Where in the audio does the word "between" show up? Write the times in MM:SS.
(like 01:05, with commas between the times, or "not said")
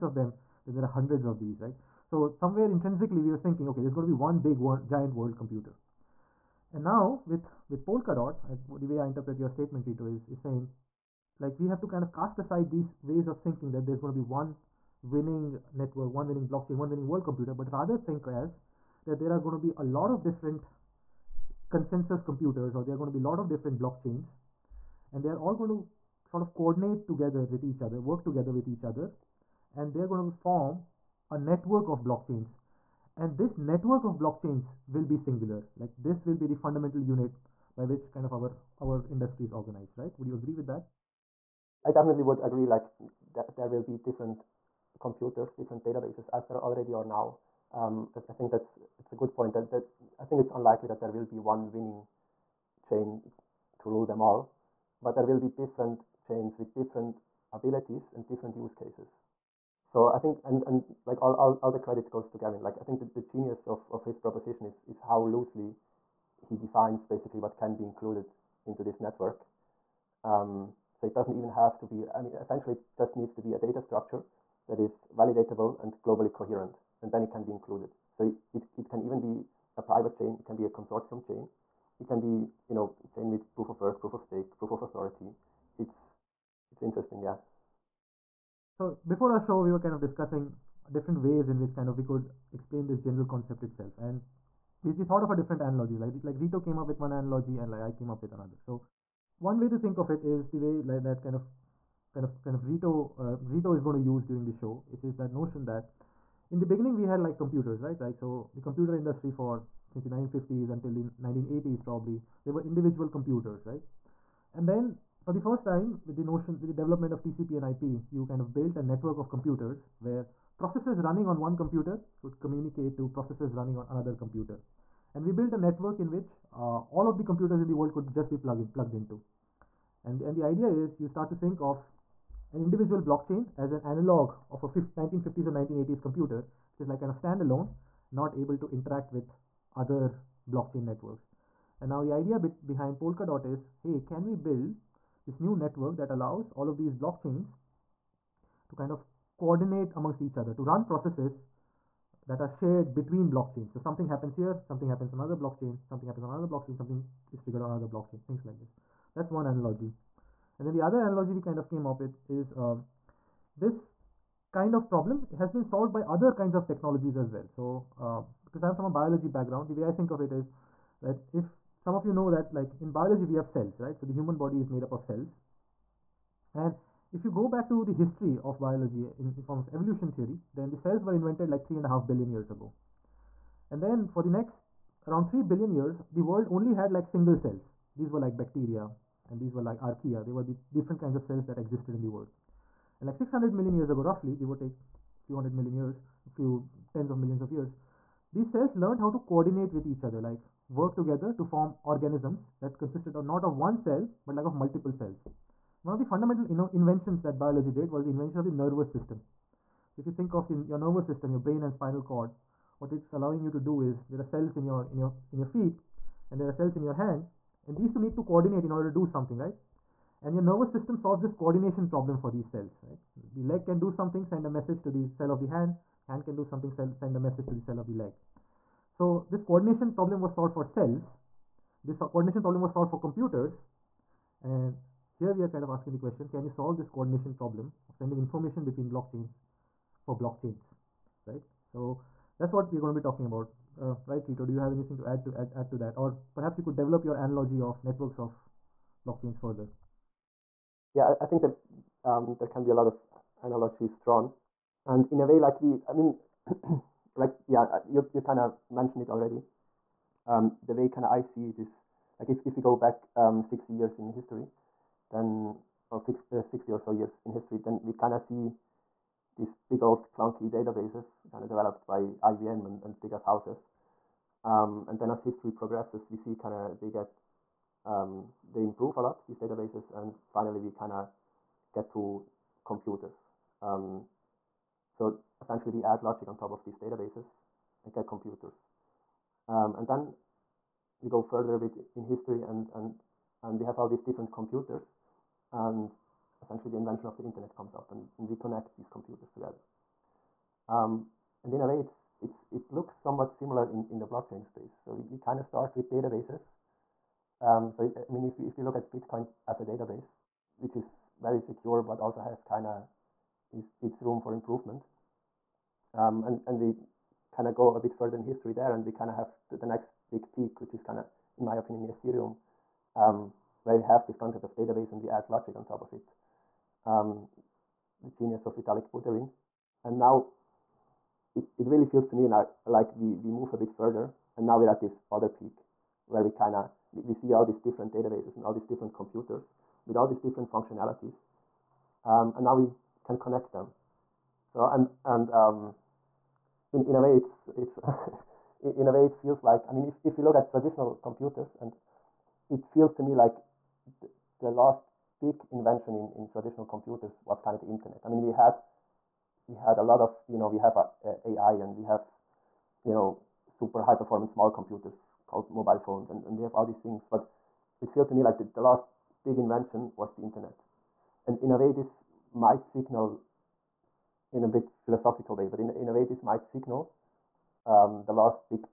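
02:32, 03:58.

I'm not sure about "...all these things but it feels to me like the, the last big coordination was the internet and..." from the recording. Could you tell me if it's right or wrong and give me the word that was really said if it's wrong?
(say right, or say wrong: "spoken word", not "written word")
wrong: "invention", not "coordination".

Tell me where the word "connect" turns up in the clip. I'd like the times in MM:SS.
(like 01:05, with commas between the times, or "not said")
04:58, 05:43.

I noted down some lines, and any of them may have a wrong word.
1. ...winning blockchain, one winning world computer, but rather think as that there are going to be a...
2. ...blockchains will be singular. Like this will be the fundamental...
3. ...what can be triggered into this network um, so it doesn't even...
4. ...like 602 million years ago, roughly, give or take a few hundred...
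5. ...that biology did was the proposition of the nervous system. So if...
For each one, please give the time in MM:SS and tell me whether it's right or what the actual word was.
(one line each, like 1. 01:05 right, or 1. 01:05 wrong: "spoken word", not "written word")
1. 00:16 right
2. 00:34 right
3. 01:07 wrong: "included", not "triggered"
4. 03:13 wrong: "600", not "602"
5. 03:27 wrong: "invention", not "proposition".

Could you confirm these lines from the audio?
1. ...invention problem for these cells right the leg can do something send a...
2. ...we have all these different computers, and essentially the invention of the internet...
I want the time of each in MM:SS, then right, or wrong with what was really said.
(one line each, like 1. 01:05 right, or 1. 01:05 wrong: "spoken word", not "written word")
1. 03:41 wrong: "coordination", not "invention"
2. 04:53 right.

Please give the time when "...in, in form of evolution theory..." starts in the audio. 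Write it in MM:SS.
02:59.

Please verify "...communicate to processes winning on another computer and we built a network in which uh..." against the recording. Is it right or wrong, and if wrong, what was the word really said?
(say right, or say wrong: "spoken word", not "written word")
wrong: "running", not "winning".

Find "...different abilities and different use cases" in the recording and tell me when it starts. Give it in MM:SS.
00:56.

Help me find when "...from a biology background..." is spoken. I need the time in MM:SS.
02:48.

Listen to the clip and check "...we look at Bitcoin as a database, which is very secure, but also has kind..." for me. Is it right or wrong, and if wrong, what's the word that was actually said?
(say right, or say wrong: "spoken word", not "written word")
right.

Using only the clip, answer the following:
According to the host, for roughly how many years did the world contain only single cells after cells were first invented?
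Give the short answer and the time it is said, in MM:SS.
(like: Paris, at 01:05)
3 billion, at 03:05.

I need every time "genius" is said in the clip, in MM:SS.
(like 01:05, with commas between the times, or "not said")
01:03, 05:28.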